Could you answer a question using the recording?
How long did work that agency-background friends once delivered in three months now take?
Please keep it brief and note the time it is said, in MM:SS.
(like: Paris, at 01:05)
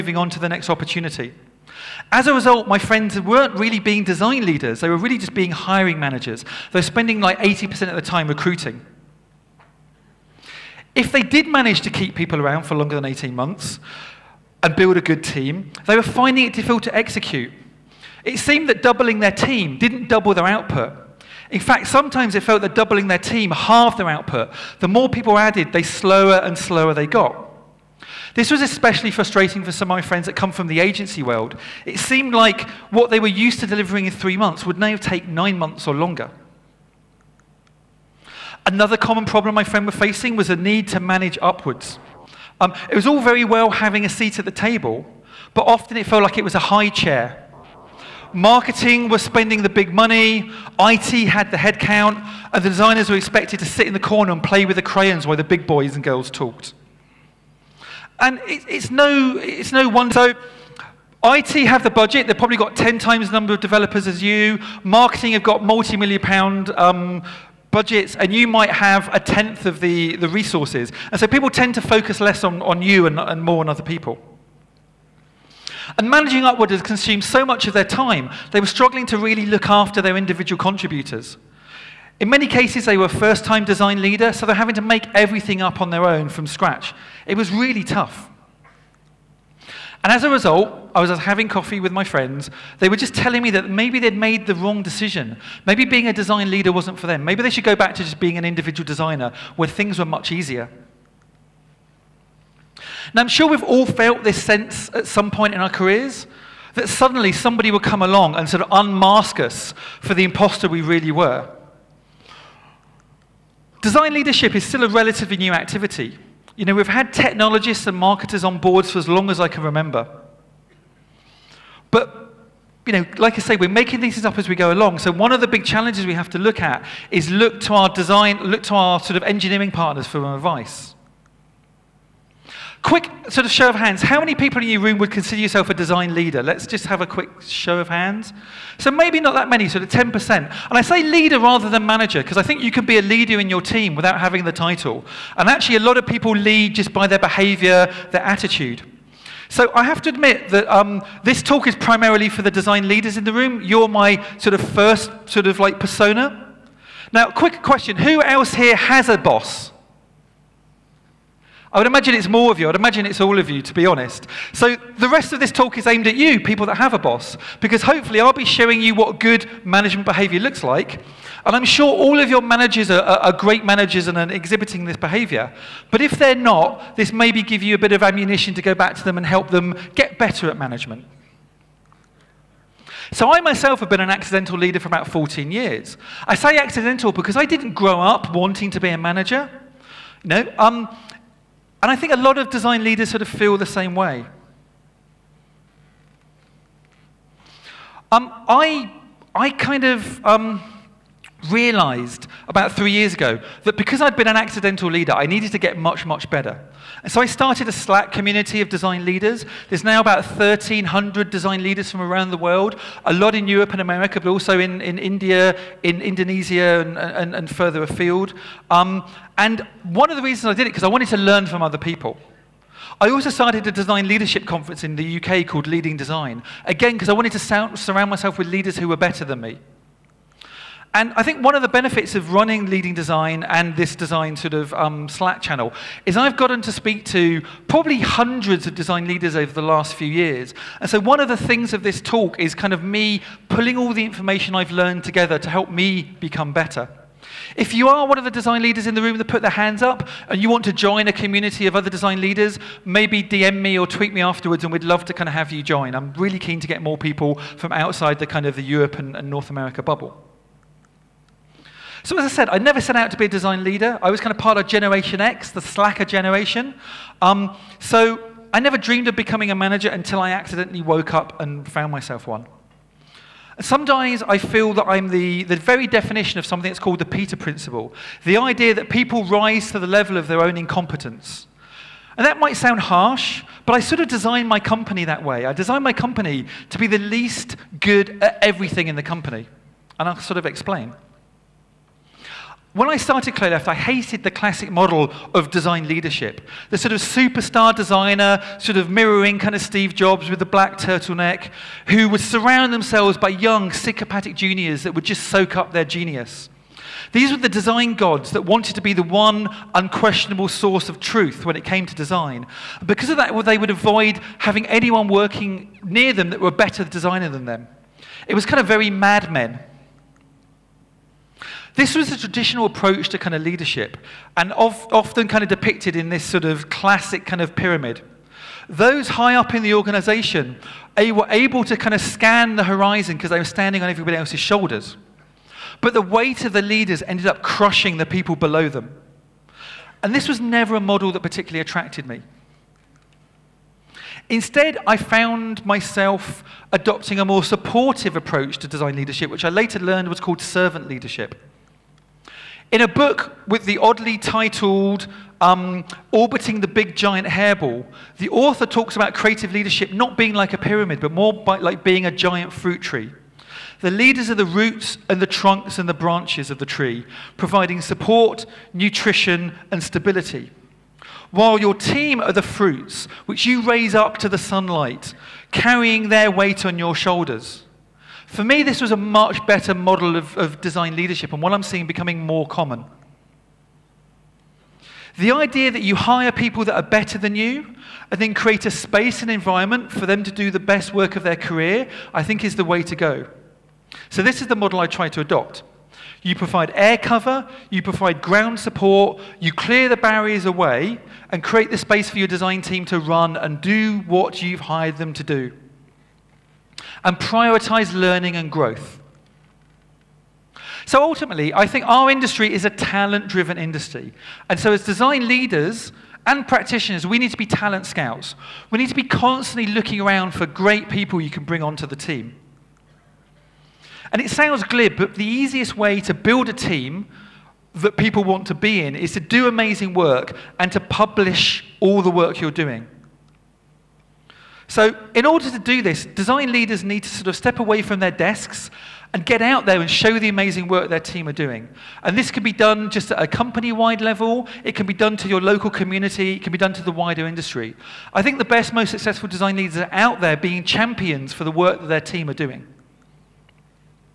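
9 months, at 00:35.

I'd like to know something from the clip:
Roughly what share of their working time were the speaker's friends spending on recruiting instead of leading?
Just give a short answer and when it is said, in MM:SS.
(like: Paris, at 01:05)
80%, at 00:07.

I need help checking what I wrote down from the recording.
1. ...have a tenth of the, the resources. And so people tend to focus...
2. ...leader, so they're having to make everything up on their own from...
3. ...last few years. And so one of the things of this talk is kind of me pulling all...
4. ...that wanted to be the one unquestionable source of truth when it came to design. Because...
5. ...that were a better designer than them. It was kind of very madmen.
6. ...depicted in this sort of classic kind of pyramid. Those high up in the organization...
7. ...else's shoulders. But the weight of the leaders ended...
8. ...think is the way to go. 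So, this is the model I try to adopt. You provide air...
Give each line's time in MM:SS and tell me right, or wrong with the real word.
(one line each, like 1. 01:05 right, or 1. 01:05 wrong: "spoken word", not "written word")
1. 01:08 right
2. 01:24 right
3. 03:59 right
4. 05:08 right
5. 05:16 right
6. 05:25 right
7. 05:34 right
8. 06:32 right.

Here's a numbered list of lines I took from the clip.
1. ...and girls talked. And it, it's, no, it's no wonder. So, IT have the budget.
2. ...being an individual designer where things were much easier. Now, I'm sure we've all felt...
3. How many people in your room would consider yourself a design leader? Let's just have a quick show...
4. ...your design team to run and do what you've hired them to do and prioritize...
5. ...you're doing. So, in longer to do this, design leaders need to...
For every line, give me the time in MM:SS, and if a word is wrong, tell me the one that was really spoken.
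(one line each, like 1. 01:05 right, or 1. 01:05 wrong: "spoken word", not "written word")
1. 00:55 right
2. 01:38 right
3. 02:14 right
4. 06:42 right
5. 07:12 wrong: "order", not "longer".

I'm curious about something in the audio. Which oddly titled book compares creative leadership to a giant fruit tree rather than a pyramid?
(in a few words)
Orbiting the Big Giant Hairball.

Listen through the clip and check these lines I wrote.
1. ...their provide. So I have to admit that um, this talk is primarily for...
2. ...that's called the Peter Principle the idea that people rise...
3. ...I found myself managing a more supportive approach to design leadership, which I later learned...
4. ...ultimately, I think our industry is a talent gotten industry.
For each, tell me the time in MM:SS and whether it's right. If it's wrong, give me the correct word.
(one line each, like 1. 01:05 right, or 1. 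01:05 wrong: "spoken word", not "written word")
1. 02:28 wrong: "attitude", not "provide"
2. 04:36 right
3. 05:44 wrong: "adopting", not "managing"
4. 06:51 wrong: "driven", not "gotten".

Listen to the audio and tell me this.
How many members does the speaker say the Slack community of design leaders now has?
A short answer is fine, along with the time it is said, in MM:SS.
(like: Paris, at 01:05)
1,300, at 03:30.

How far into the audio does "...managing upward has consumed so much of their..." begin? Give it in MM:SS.
01:16.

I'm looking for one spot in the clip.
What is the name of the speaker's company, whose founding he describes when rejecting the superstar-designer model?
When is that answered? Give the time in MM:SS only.
04:53.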